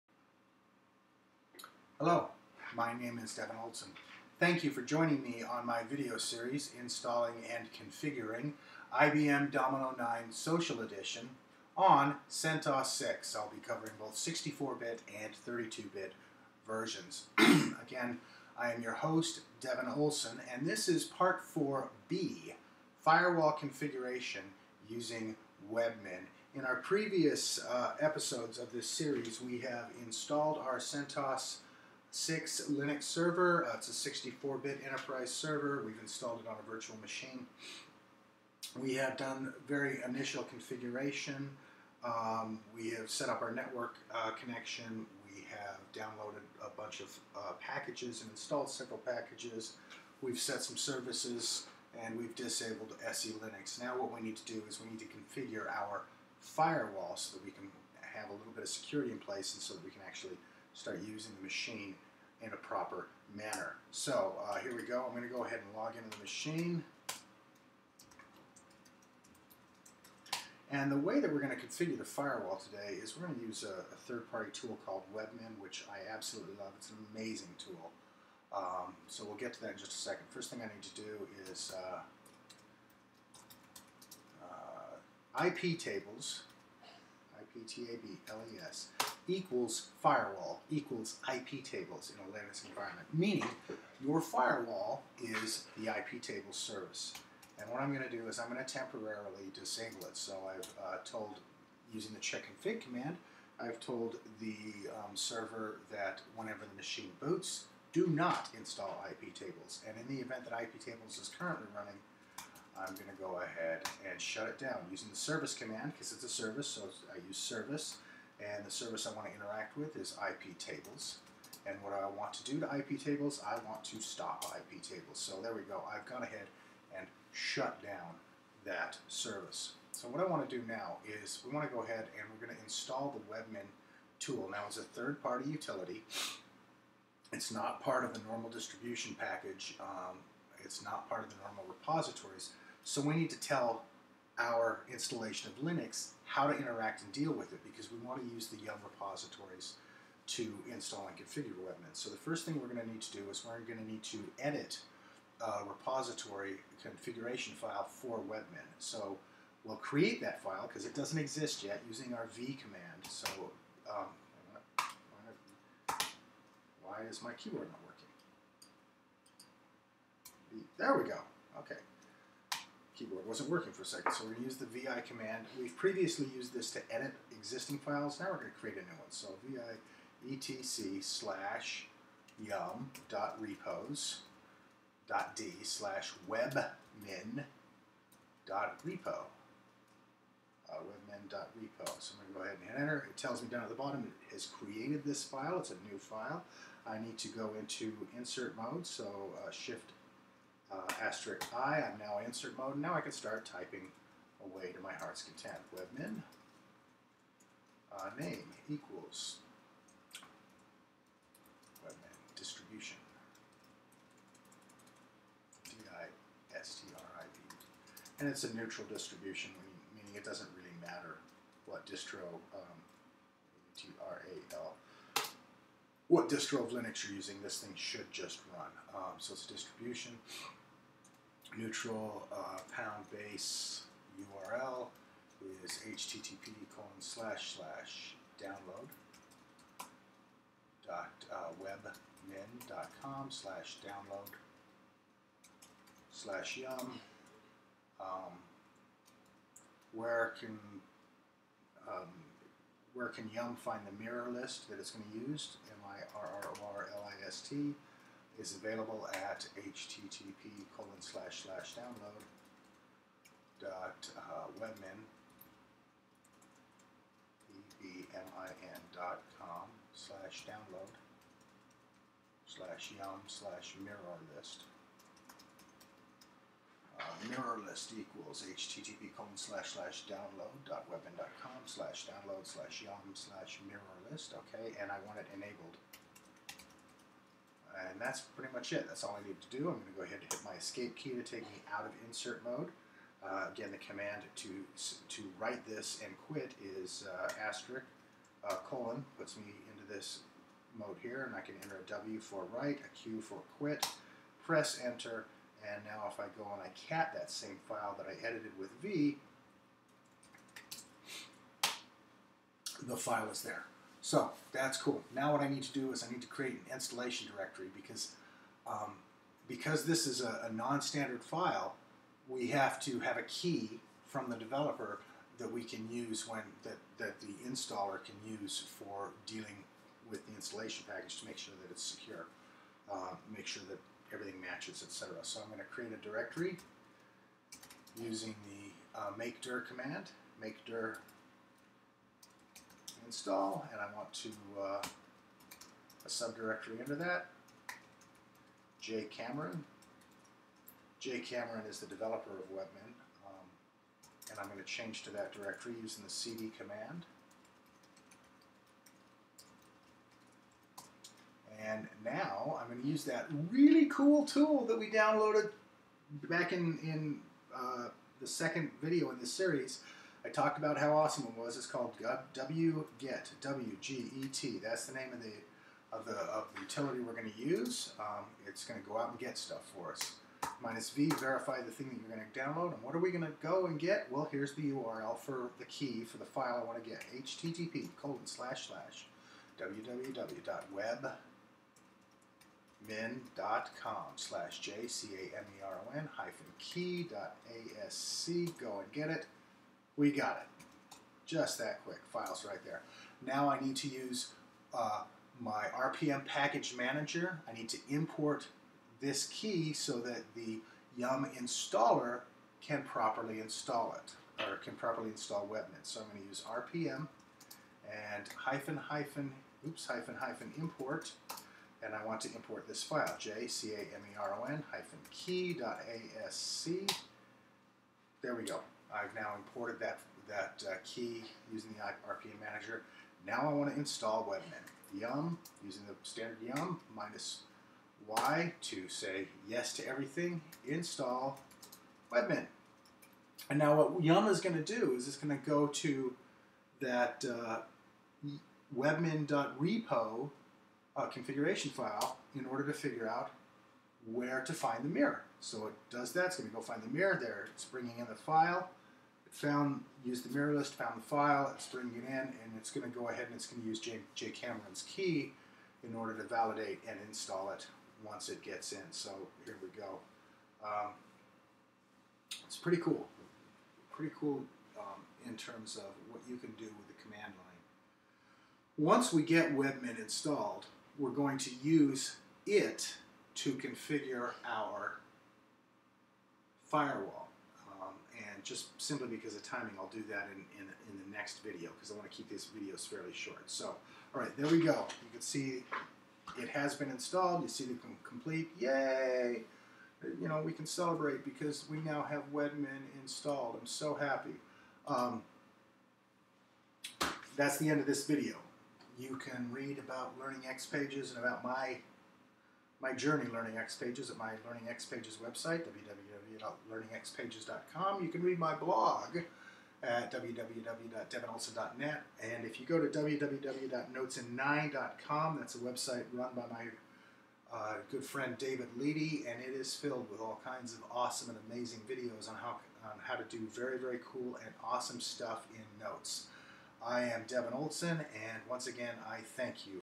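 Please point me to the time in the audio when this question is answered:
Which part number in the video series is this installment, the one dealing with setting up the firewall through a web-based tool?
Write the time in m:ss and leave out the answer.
0:21.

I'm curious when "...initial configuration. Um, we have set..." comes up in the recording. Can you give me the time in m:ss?
0:40.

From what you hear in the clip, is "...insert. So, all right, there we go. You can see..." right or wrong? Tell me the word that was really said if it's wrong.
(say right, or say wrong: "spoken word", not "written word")
wrong: "short", not "insert".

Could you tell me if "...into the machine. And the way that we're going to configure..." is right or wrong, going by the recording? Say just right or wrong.
right.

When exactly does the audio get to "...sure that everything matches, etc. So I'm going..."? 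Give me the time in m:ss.
5:33.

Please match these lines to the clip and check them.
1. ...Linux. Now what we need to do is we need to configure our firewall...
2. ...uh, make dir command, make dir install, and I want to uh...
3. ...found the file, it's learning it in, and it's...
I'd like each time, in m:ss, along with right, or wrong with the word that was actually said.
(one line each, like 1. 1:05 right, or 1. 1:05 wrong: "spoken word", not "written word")
1. 0:53 right
2. 5:38 right
3. 7:40 wrong: "bringing", not "learning".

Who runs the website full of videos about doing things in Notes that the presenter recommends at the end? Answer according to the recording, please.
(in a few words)
David Leedy.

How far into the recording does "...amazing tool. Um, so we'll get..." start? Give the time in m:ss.
1:17.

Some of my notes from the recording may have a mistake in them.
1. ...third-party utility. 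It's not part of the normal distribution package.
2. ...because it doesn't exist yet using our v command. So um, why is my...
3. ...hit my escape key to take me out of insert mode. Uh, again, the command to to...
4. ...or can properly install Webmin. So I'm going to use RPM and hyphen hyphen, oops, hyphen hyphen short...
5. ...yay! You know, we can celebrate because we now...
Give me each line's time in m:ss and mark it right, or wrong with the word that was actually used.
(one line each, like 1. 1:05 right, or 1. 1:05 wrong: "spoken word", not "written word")
1. 2:14 right
2. 2:40 right
3. 4:50 right
4. 6:54 wrong: "import", not "short"
5. 8:18 right.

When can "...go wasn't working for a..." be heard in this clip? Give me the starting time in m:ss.
2:51.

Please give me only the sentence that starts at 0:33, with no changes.
Uh, it's a 64-bit enterprise server.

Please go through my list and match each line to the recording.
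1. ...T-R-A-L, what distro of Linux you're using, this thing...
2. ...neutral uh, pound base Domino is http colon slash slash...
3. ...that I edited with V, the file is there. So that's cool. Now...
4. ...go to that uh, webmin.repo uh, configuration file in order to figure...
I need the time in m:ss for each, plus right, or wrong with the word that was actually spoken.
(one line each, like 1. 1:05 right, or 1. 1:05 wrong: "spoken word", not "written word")
1. 3:43 right
2. 3:51 wrong: "URL", not "Domino"
3. 5:07 right
4. 7:25 right.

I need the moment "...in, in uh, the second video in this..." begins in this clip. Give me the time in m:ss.
6:06.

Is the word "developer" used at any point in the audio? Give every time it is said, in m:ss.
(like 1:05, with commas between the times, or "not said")
5:24, 5:51.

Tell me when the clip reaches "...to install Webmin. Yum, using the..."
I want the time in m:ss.
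7:13.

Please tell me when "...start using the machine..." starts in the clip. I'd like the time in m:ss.
1:00.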